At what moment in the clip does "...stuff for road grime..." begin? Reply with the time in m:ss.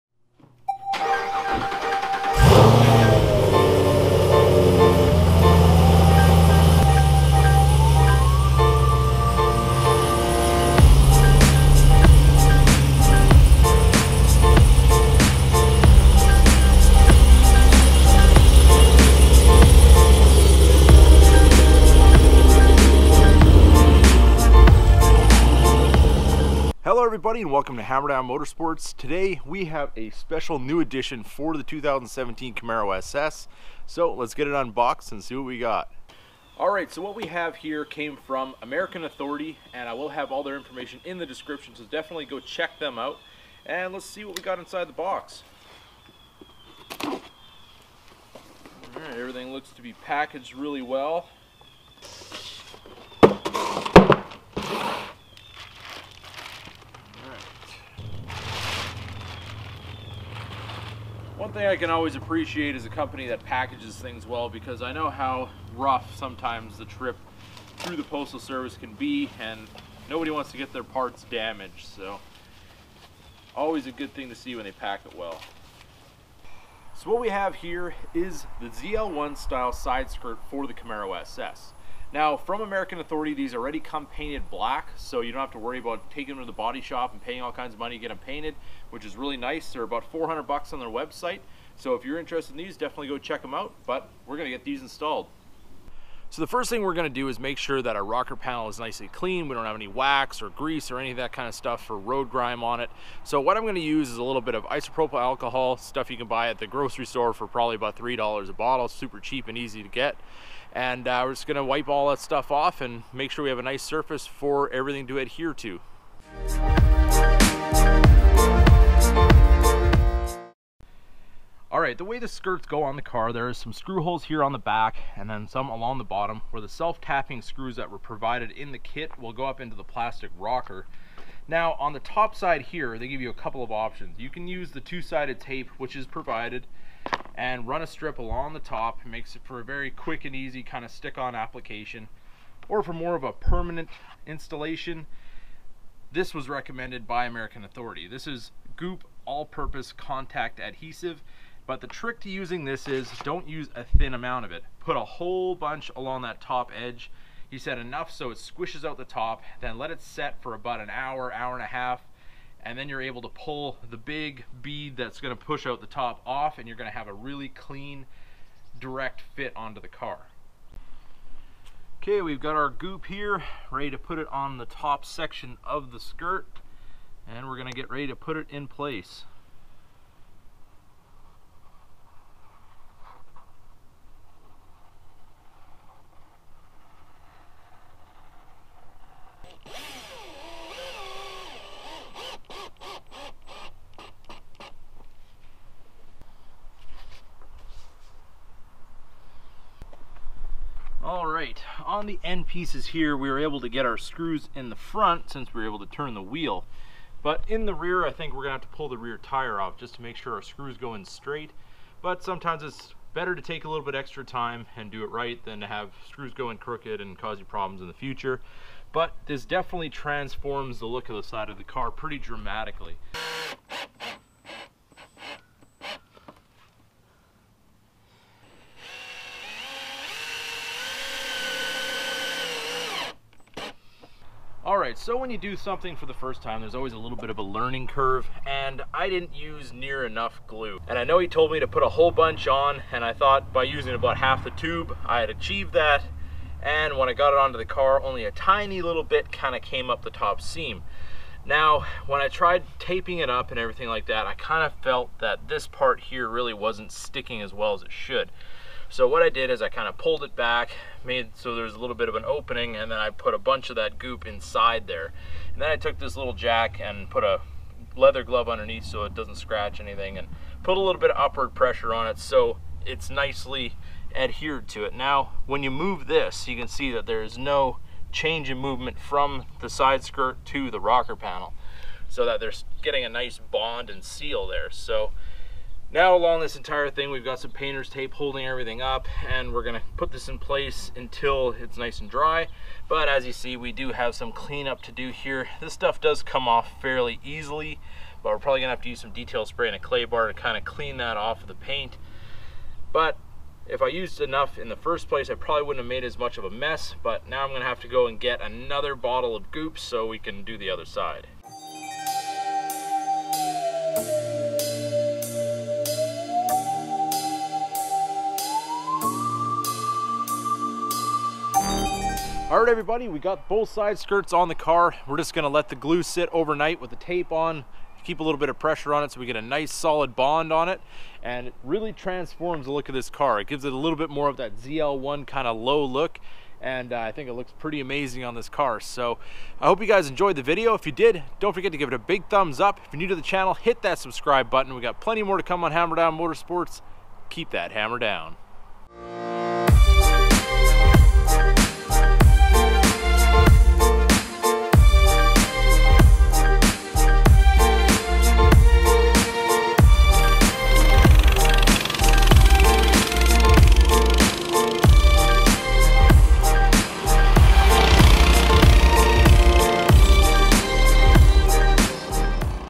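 1:41.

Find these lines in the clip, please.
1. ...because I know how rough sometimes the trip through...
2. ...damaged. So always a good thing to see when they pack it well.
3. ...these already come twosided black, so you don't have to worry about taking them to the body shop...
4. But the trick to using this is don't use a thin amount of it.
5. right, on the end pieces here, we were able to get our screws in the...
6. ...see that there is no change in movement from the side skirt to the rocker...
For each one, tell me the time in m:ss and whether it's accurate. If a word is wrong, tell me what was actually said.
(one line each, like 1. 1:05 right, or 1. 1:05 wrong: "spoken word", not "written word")
1. 1:04 right
2. 1:11 right
3. 1:23 wrong: "painted", not "twosided"
4. 2:31 right
5. 3:21 right
6. 4:36 right.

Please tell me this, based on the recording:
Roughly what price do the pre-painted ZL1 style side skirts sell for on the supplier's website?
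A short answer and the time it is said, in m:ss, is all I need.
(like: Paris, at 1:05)
$400, at 1:30.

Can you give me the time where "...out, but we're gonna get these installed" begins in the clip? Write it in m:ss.
1:33.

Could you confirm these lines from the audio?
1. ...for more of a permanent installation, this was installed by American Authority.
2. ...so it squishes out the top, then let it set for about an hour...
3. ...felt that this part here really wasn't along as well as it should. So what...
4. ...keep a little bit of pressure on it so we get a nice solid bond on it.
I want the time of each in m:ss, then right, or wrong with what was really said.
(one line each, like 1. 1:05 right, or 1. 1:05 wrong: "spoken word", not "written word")
1. 2:22 wrong: "recommended", not "installed"
2. 2:38 right
3. 4:14 wrong: "sticking", not "along"
4. 5:28 right.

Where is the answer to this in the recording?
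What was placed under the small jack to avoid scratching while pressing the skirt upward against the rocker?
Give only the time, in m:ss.
4:27.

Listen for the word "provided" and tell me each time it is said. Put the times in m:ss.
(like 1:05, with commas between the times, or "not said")
2:07, 2:16.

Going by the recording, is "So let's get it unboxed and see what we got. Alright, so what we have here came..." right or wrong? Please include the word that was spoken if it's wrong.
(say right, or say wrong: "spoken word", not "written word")
right.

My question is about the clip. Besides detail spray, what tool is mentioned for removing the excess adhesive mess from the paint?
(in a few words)
Clay bar.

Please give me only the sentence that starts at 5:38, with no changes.
So I hope you guys enjoyed the video.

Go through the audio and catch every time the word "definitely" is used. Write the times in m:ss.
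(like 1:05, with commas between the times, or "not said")
0:41, 1:32, 3:39.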